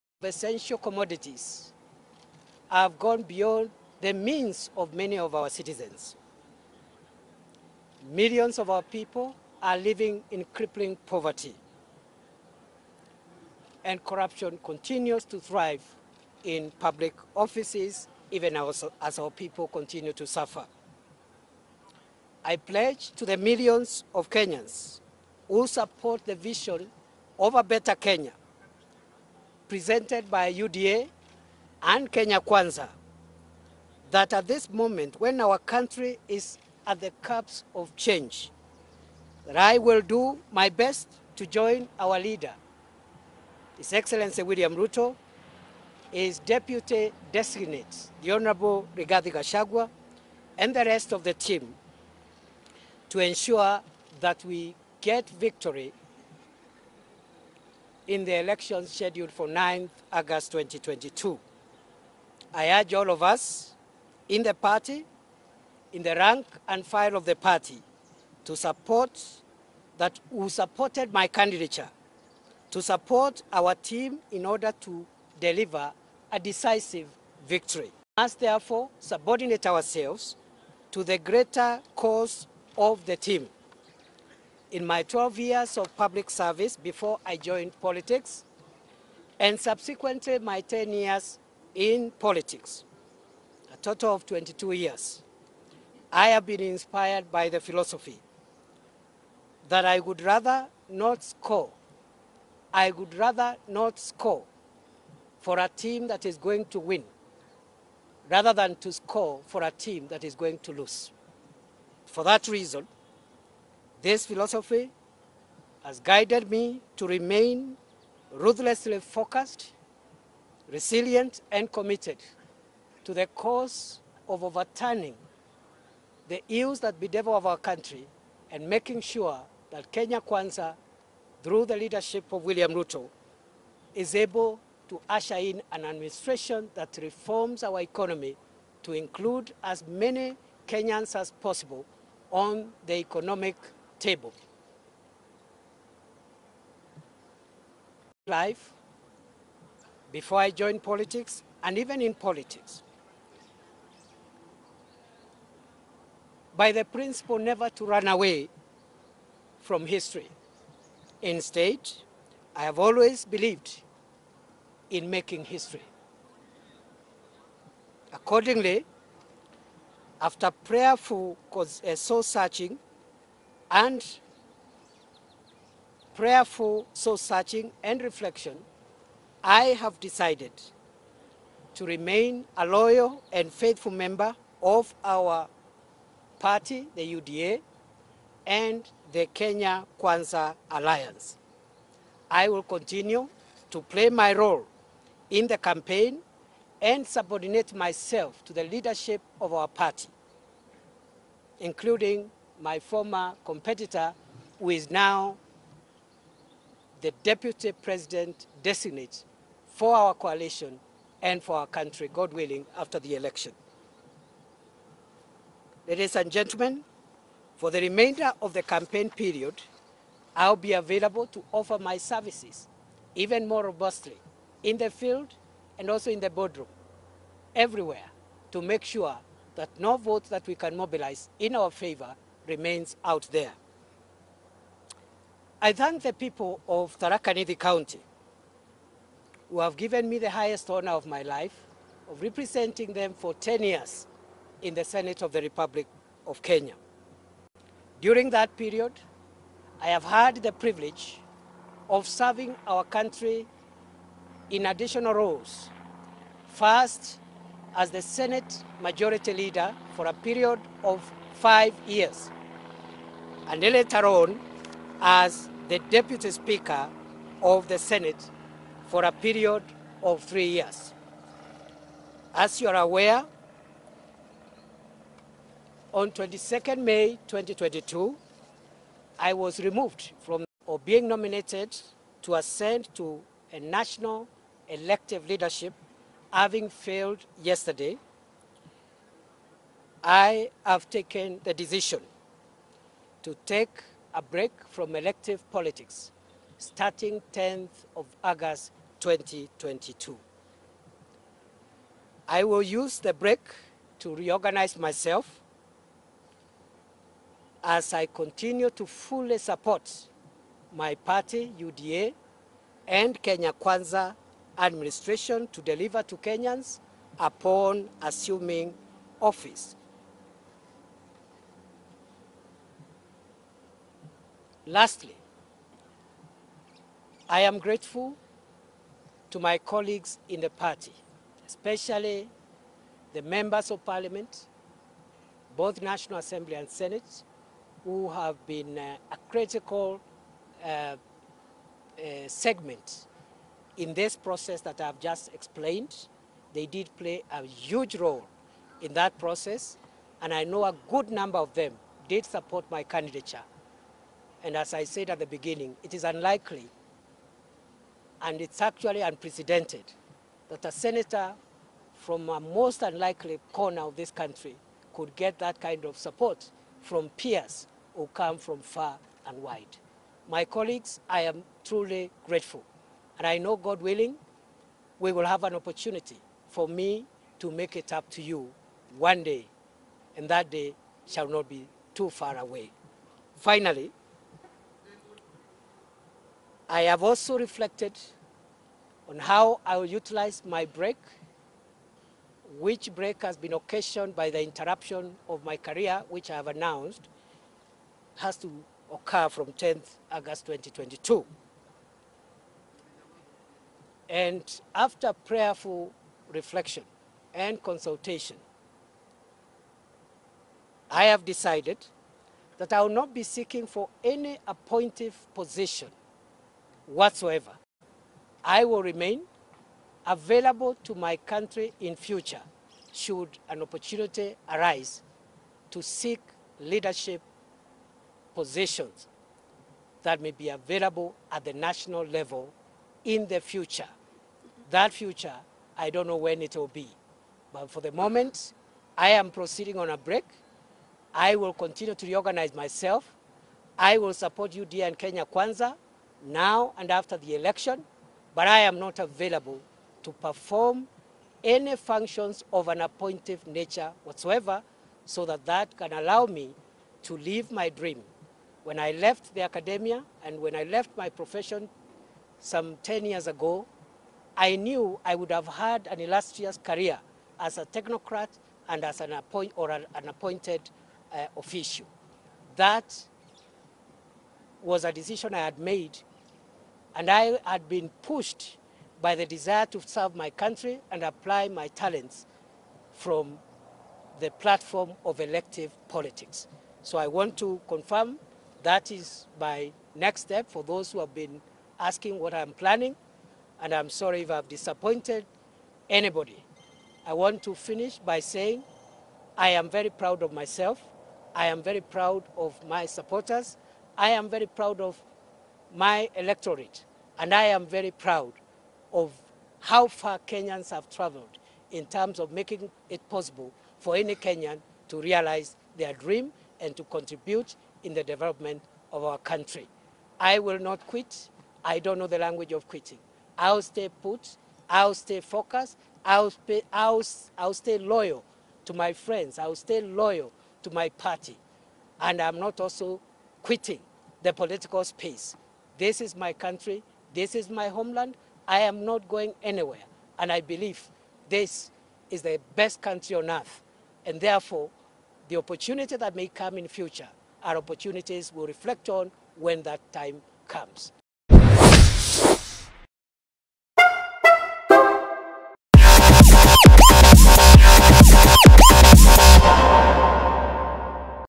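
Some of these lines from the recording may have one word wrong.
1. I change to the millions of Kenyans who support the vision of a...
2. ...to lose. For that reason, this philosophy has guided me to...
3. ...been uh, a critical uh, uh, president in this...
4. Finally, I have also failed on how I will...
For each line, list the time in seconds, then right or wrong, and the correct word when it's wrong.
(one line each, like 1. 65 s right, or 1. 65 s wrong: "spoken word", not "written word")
1. 22 s wrong: "pledge", not "change"
2. 110 s right
3. 338 s wrong: "segment", not "president"
4. 383 s wrong: "reflected", not "failed".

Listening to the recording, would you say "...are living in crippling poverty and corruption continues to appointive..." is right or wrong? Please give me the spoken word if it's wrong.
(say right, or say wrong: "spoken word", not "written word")
wrong: "thrive", not "appointive".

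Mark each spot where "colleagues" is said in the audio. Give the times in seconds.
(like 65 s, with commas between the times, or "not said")
329 s, 370 s.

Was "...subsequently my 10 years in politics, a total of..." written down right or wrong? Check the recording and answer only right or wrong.
right.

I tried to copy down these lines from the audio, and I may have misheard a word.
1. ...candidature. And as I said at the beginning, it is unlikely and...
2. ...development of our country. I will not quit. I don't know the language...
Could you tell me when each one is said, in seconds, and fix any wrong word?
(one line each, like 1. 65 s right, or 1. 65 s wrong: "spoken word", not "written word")
1. 352 s right
2. 518 s right.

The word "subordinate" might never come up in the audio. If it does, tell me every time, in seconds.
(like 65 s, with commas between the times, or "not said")
78 s, 197 s.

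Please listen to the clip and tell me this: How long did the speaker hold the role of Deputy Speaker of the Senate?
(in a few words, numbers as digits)
3 years.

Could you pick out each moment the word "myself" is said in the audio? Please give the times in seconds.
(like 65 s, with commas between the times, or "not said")
197 s, 304 s, 442 s, 500 s.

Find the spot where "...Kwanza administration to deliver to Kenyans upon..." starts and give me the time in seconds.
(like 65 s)
313 s.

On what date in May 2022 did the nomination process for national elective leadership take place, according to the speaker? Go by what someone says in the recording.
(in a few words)
22nd May 2022.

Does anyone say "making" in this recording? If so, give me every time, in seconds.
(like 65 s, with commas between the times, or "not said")
128 s, 165 s, 512 s.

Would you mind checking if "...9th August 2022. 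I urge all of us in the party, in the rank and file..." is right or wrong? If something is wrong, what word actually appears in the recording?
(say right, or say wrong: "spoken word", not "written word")
right.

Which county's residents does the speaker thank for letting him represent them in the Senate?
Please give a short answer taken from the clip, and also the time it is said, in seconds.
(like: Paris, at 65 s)
Tharaka-Nithi, at 236 s.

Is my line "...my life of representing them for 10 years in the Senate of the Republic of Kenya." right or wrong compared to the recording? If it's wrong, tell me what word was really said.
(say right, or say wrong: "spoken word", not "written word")
right.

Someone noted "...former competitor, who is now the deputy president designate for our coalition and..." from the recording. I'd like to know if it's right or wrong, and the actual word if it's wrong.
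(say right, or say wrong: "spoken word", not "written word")
right.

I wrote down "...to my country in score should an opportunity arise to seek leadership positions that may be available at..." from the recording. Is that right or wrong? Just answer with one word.
wrong.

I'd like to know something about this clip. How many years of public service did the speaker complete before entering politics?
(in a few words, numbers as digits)
12.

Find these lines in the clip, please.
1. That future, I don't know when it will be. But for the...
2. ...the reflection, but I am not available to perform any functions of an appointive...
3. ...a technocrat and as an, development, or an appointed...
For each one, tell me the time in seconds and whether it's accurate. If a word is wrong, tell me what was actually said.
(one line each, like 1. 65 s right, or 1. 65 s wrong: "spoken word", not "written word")
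1. 434 s right
2. 447 s wrong: "election", not "reflection"
3. 467 s wrong: "appoint", not "development".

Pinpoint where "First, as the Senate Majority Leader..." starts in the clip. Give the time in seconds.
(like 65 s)
256 s.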